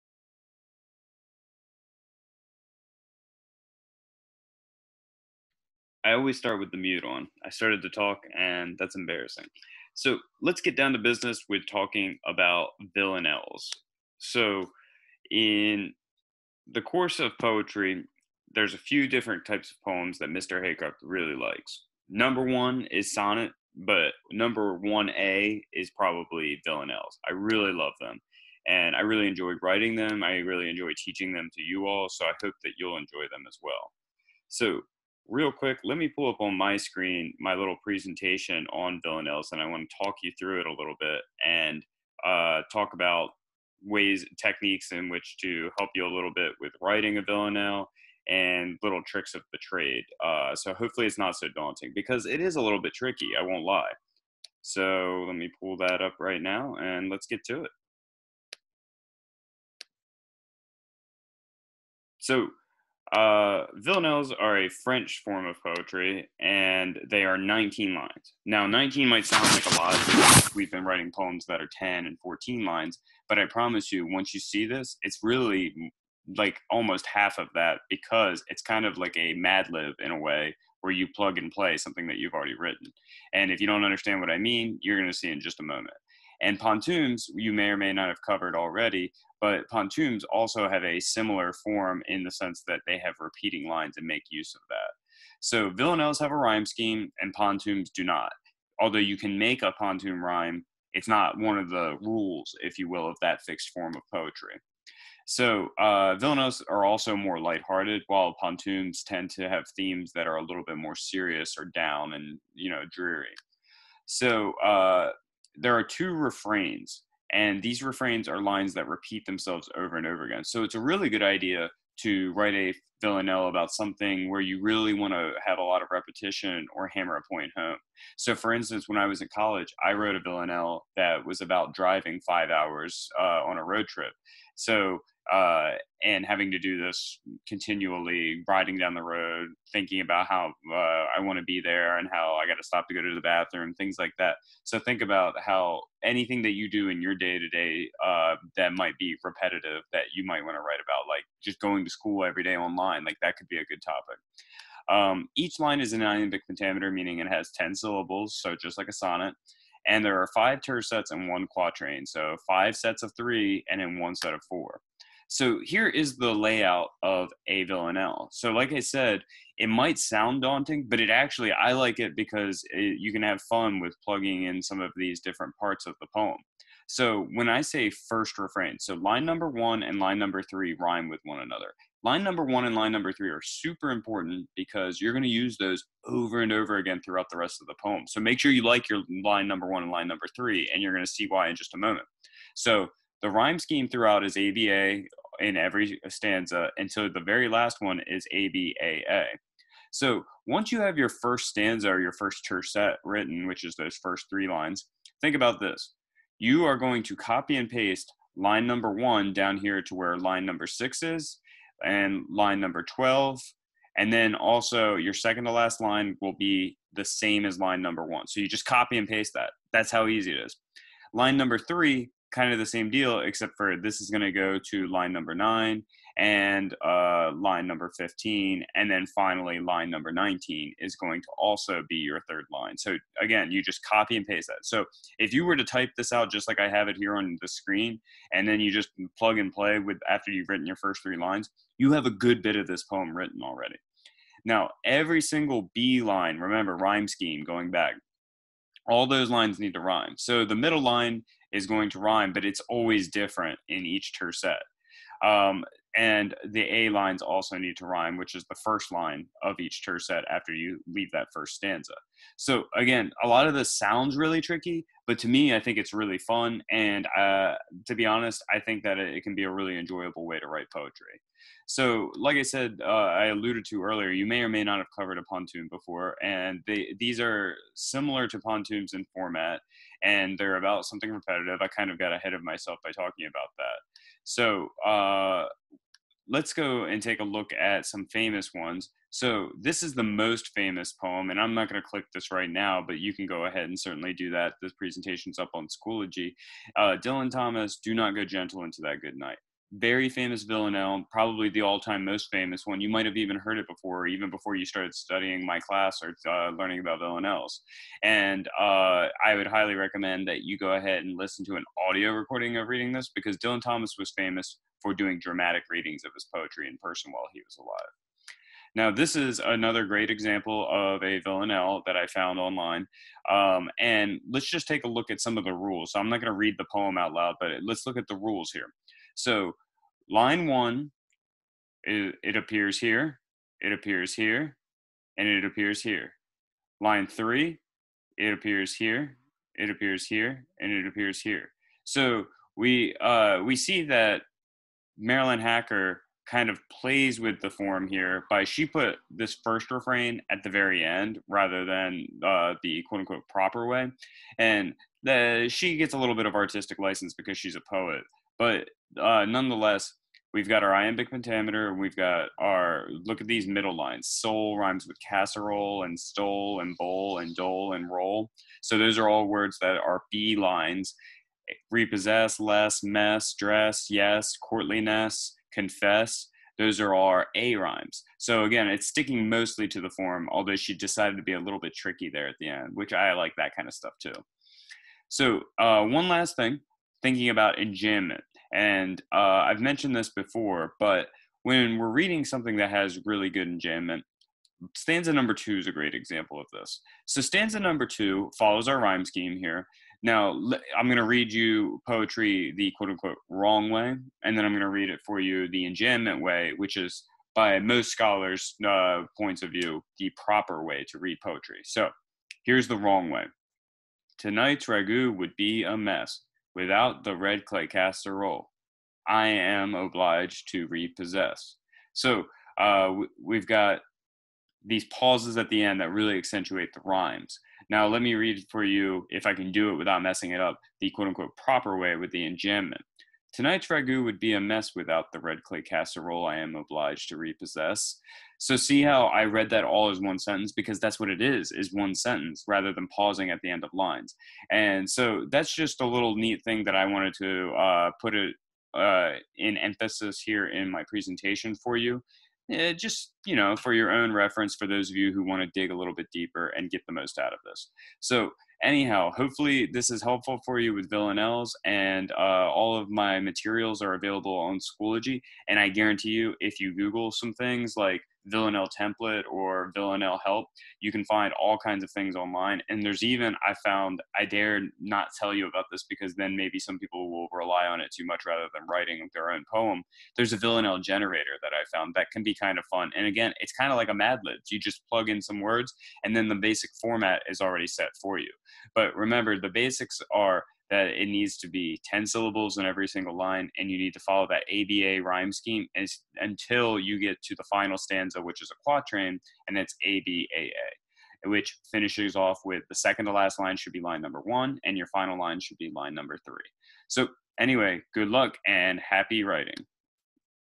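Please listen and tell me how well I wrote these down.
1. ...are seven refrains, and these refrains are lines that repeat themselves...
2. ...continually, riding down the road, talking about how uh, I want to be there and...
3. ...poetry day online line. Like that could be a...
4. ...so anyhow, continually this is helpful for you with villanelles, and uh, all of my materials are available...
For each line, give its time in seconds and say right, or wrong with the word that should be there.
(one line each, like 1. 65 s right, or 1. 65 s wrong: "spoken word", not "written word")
1. 115 s wrong: "two", not "seven"
2. 137 s wrong: "thinking", not "talking"
3. 152 s wrong: "every", not "poetry"
4. 458 s wrong: "hopefully", not "continually".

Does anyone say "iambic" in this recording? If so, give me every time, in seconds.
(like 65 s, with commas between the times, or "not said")
156 s, 360 s.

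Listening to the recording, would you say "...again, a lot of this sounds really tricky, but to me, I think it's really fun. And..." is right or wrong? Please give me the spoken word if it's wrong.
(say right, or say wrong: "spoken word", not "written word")
right.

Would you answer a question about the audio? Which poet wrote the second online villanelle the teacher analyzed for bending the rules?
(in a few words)
Marilyn Hacker.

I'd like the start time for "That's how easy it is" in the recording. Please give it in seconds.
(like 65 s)
219 s.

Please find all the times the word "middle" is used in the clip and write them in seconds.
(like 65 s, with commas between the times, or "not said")
250 s, 363 s.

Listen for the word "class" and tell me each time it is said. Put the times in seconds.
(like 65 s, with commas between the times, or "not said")
305 s.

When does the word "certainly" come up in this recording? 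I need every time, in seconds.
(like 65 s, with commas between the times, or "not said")
293 s.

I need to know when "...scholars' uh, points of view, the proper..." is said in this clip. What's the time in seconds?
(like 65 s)
407 s.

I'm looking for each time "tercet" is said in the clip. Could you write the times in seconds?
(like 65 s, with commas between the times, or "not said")
160 s, 202 s, 254 s, 259 s.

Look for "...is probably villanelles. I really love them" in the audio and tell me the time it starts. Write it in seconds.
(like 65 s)
25 s.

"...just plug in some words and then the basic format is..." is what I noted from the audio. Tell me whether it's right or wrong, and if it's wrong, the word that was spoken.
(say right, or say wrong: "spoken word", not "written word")
right.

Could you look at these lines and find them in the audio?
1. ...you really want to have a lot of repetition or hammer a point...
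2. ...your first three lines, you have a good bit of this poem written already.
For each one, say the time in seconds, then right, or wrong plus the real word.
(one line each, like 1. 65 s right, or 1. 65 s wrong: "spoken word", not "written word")
1. 124 s right
2. 240 s right.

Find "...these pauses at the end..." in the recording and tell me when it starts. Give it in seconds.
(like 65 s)
424 s.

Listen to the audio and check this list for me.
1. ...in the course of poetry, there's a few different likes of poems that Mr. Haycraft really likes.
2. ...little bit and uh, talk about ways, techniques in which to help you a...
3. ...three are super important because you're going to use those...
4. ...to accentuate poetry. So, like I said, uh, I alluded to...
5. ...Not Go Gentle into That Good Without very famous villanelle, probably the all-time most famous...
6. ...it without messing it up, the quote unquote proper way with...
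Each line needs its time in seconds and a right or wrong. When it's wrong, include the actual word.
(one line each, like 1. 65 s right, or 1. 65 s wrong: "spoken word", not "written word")
1. 15 s wrong: "types", not "likes"
2. 40 s right
3. 183 s right
4. 270 s wrong: "write", not "accentuate"
5. 297 s wrong: "Night", not "Without"
6. 429 s right.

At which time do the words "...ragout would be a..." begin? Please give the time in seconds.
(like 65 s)
414 s.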